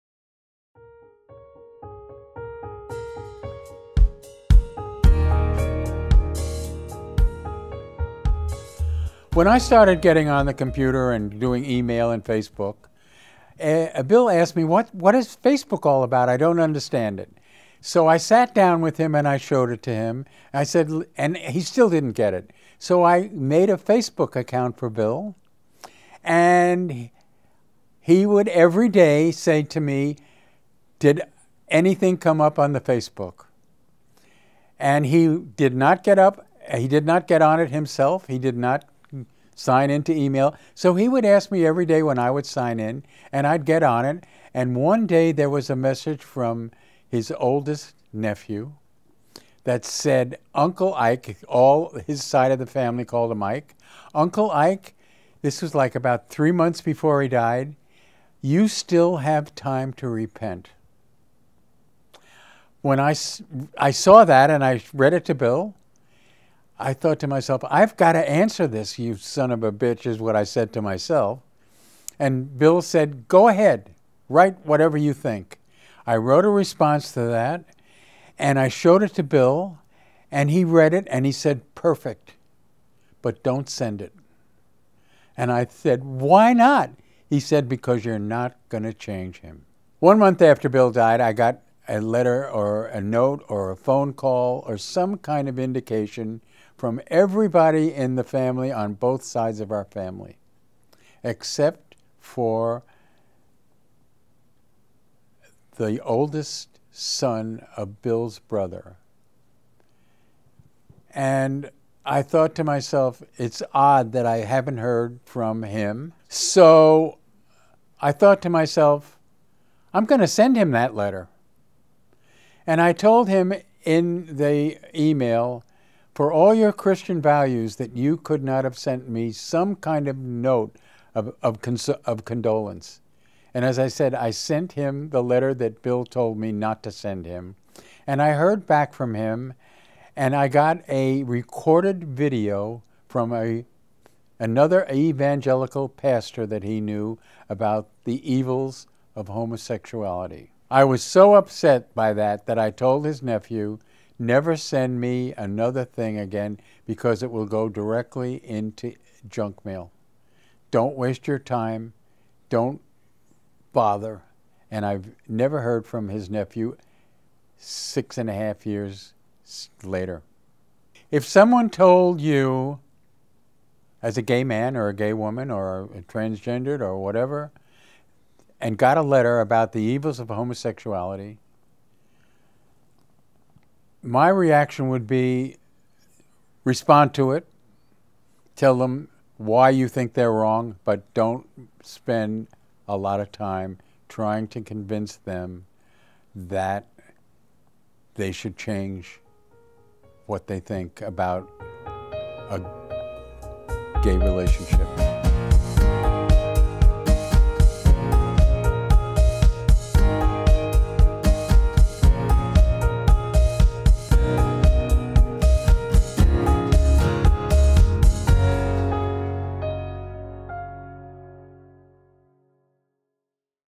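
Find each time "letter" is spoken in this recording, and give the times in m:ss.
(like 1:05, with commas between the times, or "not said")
1:32, 2:00, 2:15, 2:59.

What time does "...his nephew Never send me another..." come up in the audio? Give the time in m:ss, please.
2:33.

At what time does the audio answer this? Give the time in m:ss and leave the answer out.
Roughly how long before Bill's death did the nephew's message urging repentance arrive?
0:56.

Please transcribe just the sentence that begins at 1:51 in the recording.
And I thought to myself, it's odd that I haven't heard from him.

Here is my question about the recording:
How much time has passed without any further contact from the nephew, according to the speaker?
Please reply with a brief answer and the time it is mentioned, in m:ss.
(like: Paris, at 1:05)
6 and a half years, at 2:47.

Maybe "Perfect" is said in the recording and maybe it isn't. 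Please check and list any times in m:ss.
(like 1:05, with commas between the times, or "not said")
1:21.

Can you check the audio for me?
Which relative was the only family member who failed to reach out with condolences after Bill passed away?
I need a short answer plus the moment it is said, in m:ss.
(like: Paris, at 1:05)
The oldest son of Bill's brother, at 1:45.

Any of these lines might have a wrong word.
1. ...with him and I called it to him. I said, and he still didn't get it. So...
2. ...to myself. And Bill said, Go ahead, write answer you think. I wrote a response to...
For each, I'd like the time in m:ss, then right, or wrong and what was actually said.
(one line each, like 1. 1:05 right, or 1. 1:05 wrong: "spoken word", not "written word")
1. 0:18 wrong: "showed", not "called"
2. 1:10 wrong: "whatever", not "answer".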